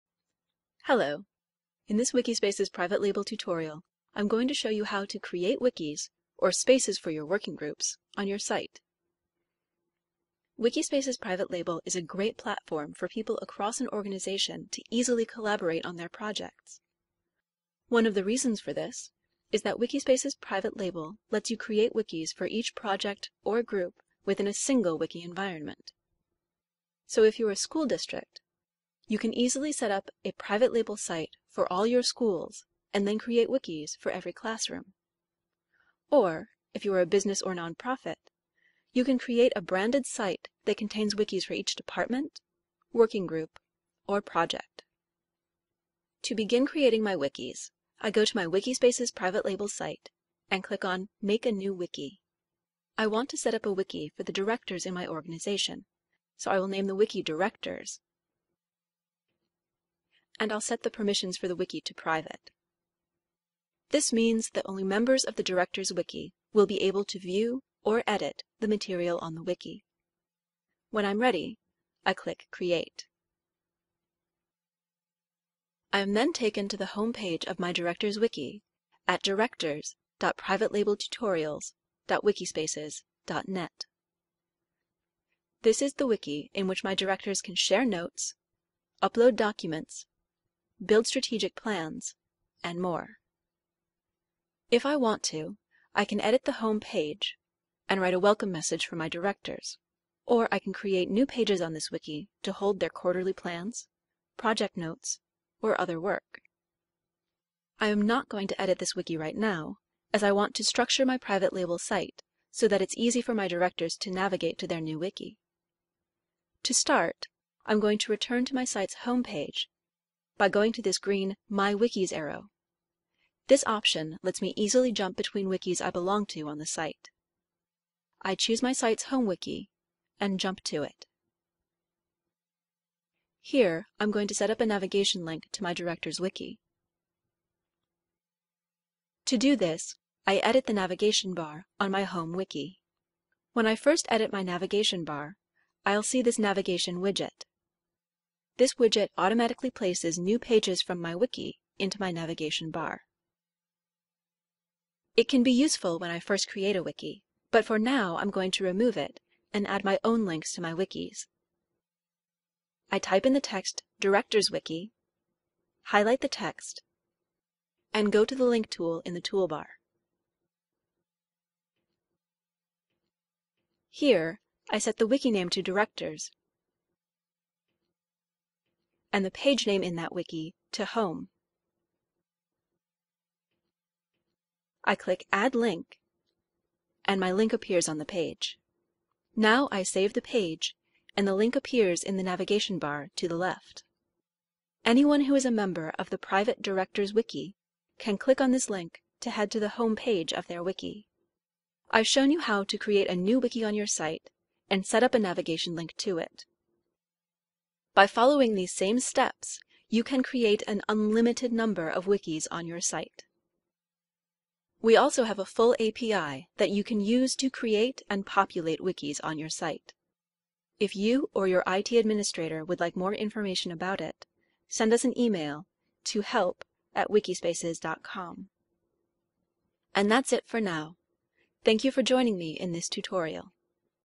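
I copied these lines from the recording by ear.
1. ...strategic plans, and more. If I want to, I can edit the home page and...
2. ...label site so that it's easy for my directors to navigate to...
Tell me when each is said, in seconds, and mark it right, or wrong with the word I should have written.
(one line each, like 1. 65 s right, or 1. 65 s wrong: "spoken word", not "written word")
1. 91 s right
2. 111 s right.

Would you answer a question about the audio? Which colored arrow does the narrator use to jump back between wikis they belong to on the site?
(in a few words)
Green.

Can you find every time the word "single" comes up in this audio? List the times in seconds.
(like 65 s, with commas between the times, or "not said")
24 s.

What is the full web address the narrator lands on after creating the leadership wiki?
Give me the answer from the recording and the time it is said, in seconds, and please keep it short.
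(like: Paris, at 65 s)
directors.privatelabeltutorials.wikispaces.net, at 79 s.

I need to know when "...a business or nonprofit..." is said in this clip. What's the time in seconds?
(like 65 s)
37 s.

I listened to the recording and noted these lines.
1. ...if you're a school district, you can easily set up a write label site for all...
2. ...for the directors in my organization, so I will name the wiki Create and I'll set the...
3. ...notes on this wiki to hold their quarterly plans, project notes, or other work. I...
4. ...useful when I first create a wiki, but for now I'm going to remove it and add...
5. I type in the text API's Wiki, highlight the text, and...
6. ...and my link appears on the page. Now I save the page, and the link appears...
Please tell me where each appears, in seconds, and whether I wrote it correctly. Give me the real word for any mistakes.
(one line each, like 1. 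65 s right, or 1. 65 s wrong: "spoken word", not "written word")
1. 27 s wrong: "private", not "write"
2. 54 s wrong: "Directors", not "Create"
3. 101 s wrong: "pages", not "notes"
4. 155 s right
5. 162 s wrong: "Director", not "API"
6. 187 s right.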